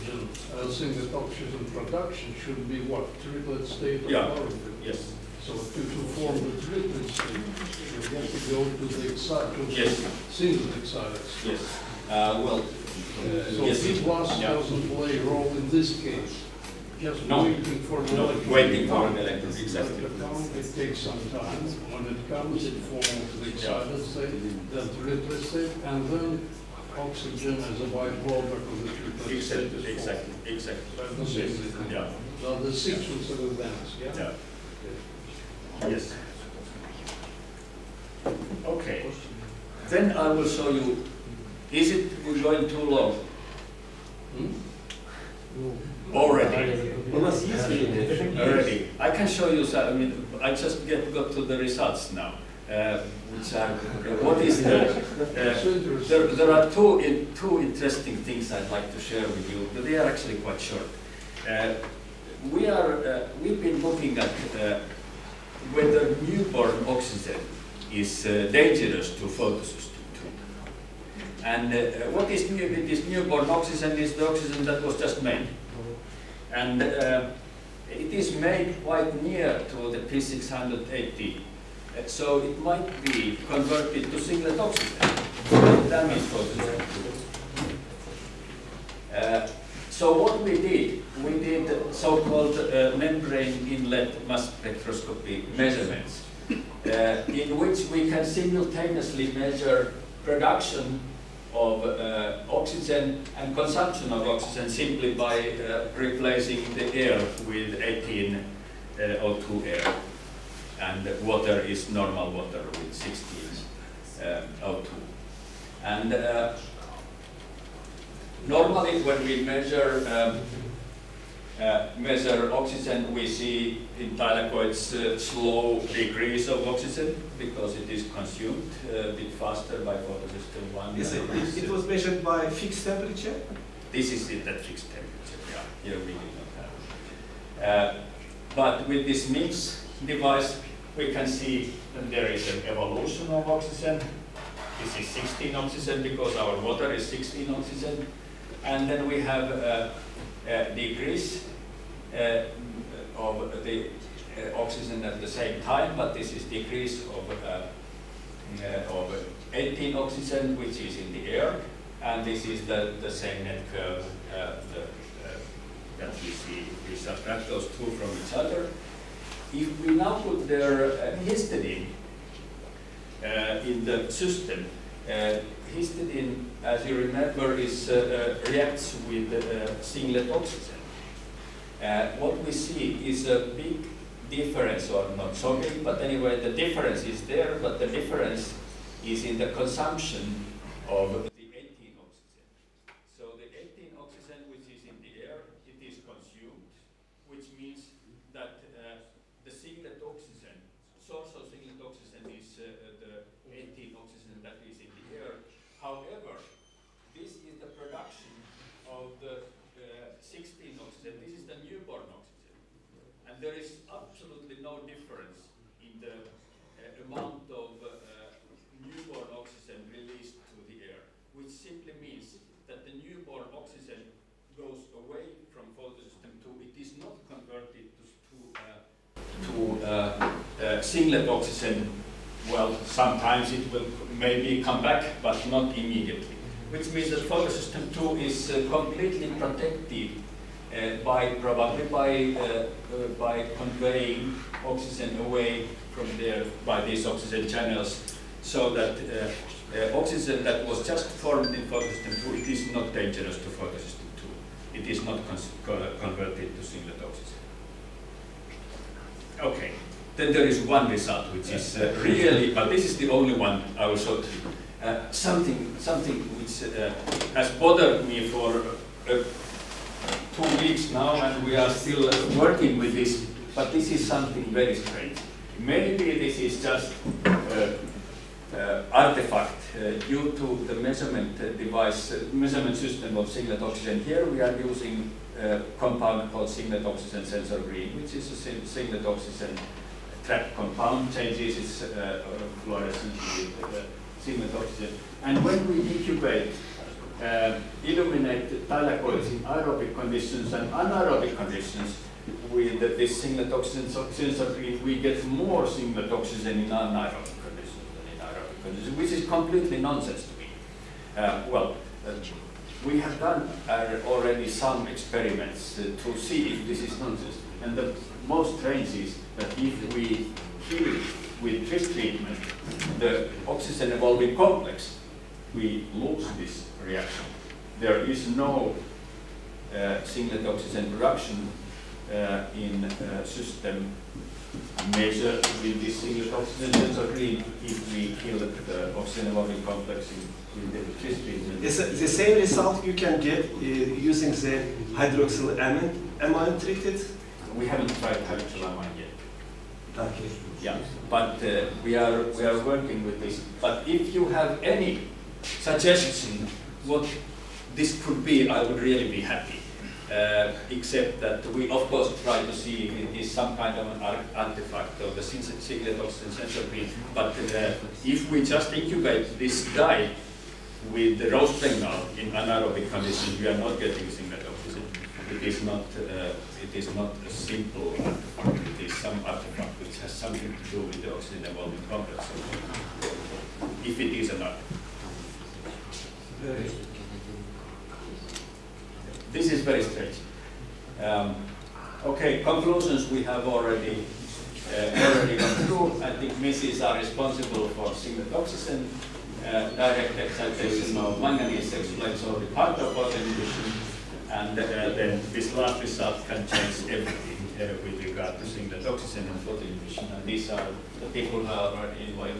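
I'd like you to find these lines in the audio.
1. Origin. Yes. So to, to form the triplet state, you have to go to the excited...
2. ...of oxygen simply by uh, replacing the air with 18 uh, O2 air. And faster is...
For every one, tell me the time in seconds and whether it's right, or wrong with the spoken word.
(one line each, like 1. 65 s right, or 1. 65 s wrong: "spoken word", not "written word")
1. 4 s right
2. 104 s wrong: "water", not "faster".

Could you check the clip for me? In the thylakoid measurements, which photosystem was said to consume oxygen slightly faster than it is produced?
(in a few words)
Photosystem 1.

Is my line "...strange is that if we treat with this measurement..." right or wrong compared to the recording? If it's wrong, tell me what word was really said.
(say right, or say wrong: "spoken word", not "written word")
wrong: "treatment", not "measurement".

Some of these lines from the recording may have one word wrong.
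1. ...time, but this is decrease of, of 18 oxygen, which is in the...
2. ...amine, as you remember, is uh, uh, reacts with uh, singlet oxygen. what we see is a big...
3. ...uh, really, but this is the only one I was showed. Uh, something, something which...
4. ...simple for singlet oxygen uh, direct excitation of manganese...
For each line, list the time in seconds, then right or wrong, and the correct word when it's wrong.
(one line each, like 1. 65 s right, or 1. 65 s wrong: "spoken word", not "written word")
1. 155 s right
2. 175 s wrong: "histidine", not "amine"
3. 261 s right
4. 396 s wrong: "responsible", not "simple".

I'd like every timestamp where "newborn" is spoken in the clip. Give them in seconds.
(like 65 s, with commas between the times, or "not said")
66 s, 73 s, 211 s, 218 s, 222 s.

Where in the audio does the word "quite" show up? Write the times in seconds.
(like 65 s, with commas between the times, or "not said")
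60 s, 78 s.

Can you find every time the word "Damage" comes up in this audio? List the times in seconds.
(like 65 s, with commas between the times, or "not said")
85 s.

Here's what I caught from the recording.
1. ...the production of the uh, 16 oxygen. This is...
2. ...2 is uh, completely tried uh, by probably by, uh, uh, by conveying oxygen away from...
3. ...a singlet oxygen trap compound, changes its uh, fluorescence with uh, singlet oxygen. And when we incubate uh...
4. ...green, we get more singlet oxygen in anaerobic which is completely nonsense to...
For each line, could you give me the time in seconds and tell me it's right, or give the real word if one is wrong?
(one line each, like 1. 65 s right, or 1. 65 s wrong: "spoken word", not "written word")
1. 207 s right
2. 237 s wrong: "protected", not "tried"
3. 288 s right
4. 304 s right.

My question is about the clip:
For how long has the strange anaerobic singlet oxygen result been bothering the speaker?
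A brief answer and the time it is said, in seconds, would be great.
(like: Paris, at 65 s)
Two weeks, at 270 s.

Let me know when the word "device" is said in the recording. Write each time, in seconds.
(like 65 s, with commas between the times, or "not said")
140 s, 281 s.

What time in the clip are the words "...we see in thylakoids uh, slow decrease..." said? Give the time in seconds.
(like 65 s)
123 s.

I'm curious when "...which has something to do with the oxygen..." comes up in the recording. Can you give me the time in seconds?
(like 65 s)
379 s.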